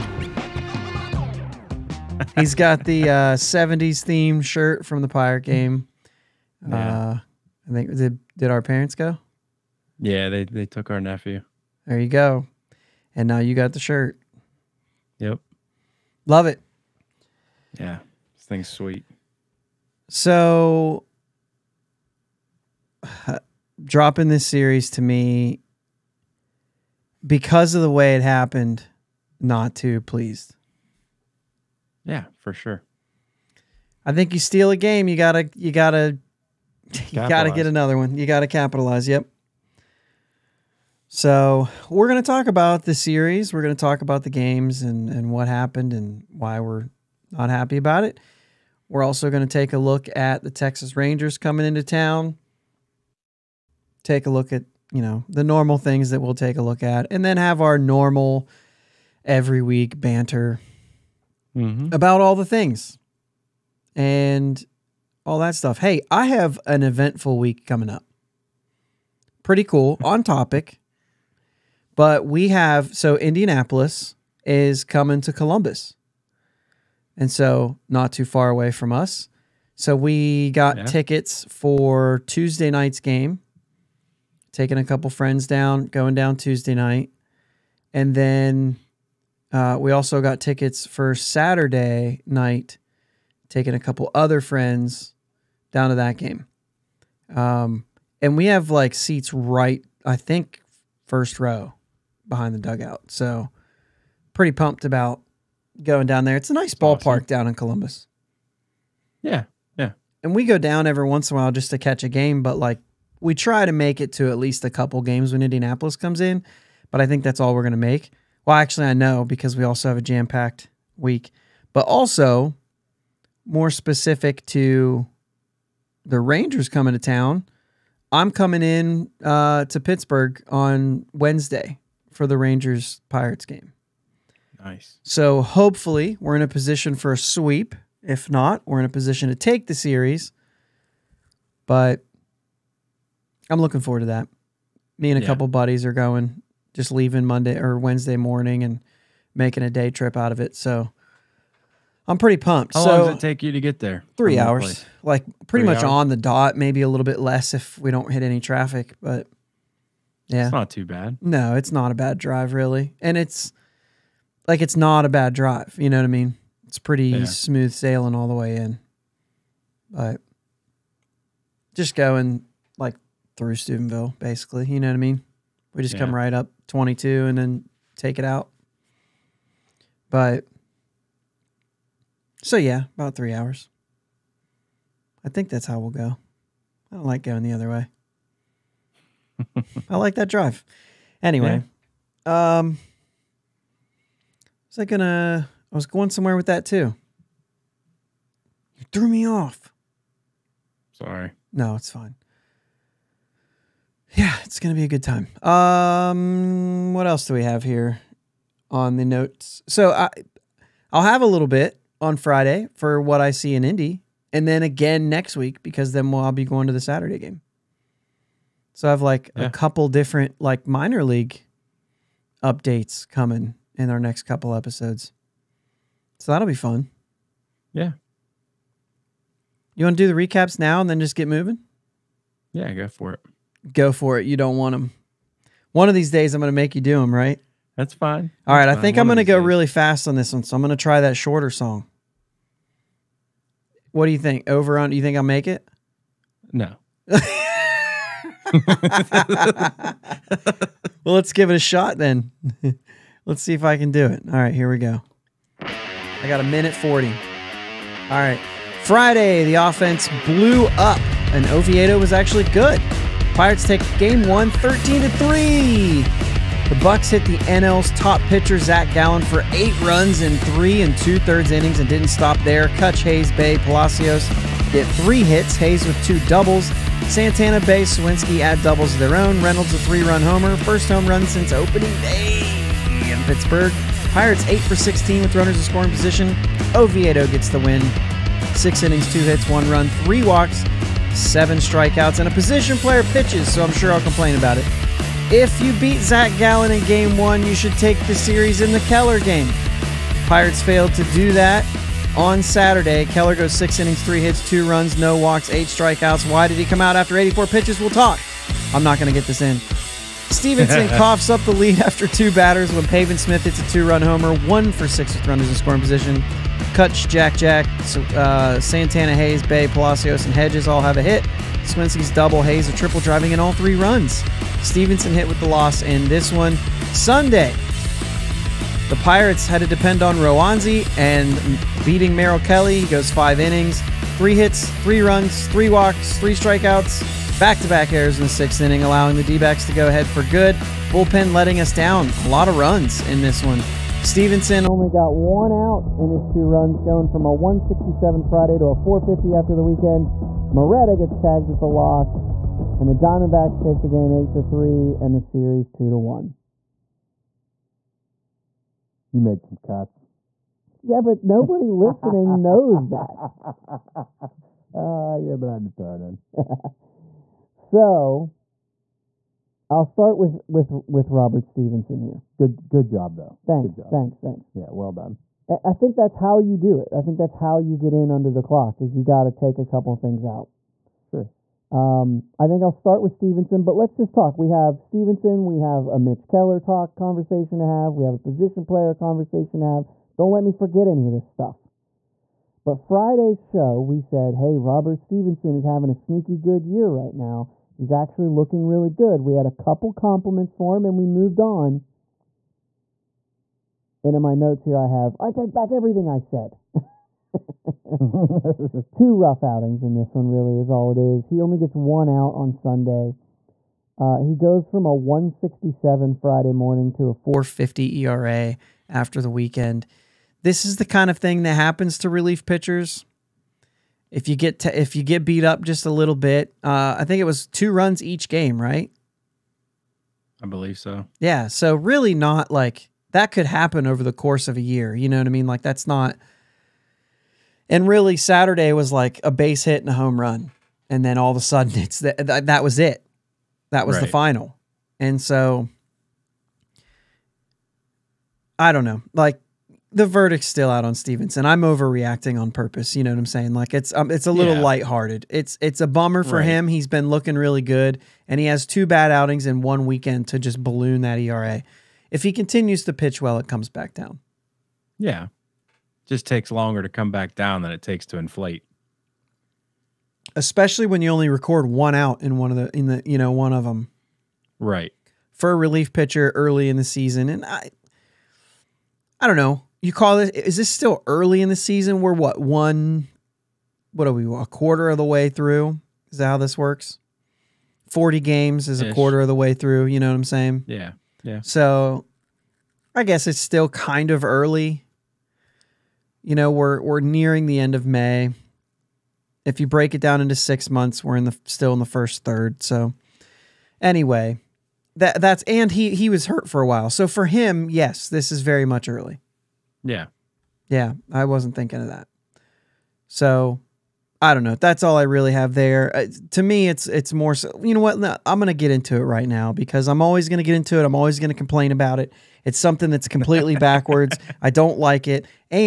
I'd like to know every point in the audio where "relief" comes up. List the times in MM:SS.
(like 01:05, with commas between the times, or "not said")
07:02, 07:55.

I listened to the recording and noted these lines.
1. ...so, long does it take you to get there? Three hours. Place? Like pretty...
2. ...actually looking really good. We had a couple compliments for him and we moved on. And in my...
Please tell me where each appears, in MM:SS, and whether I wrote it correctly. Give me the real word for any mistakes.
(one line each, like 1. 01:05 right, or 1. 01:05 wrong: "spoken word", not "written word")
1. 02:32 right
2. 06:37 right.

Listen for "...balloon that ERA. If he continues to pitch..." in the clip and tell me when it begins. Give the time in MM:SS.
07:40.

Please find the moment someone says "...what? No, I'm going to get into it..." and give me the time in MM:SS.
08:37.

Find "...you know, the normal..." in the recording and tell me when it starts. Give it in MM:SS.
00:54.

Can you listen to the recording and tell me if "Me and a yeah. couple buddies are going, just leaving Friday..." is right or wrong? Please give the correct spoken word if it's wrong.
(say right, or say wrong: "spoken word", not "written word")
wrong: "Monday", not "Friday".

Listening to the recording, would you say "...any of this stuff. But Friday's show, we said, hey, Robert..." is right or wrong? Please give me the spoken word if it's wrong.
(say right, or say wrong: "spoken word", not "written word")
right.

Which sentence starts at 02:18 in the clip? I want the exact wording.
If not, we're in a position to take the series.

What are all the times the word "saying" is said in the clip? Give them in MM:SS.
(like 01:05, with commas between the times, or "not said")
07:33, 08:10.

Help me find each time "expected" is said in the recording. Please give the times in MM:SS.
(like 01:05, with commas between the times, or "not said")
not said.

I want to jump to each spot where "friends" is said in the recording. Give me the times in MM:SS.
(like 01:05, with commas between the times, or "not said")
01:25, 01:34.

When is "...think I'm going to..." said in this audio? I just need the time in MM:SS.
03:58.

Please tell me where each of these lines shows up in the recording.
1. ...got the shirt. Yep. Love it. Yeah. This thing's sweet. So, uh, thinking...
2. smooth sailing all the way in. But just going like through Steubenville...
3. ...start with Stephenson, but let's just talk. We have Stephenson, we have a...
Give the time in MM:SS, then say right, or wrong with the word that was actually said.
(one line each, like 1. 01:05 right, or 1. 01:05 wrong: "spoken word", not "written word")
1. 00:13 wrong: "dropping", not "thinking"
2. 02:47 right
3. 06:22 right.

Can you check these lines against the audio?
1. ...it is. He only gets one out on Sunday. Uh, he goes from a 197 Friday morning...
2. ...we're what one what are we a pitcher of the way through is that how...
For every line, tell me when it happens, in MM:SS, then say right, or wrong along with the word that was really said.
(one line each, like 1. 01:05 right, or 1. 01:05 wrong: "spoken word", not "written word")
1. 06:50 wrong: "167", not "197"
2. 08:02 wrong: "quarter", not "pitcher".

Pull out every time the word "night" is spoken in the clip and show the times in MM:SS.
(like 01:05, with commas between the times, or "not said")
01:22, 01:26, 01:32.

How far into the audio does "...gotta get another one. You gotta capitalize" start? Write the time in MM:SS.
00:37.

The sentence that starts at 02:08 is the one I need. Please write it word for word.
I'm coming in uh, to Pittsburgh on Wednesday for the Rangers Pirates game.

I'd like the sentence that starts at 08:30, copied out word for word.
Yeah, I wasn't thinking of that.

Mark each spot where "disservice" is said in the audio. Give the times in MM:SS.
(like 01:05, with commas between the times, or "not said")
not said.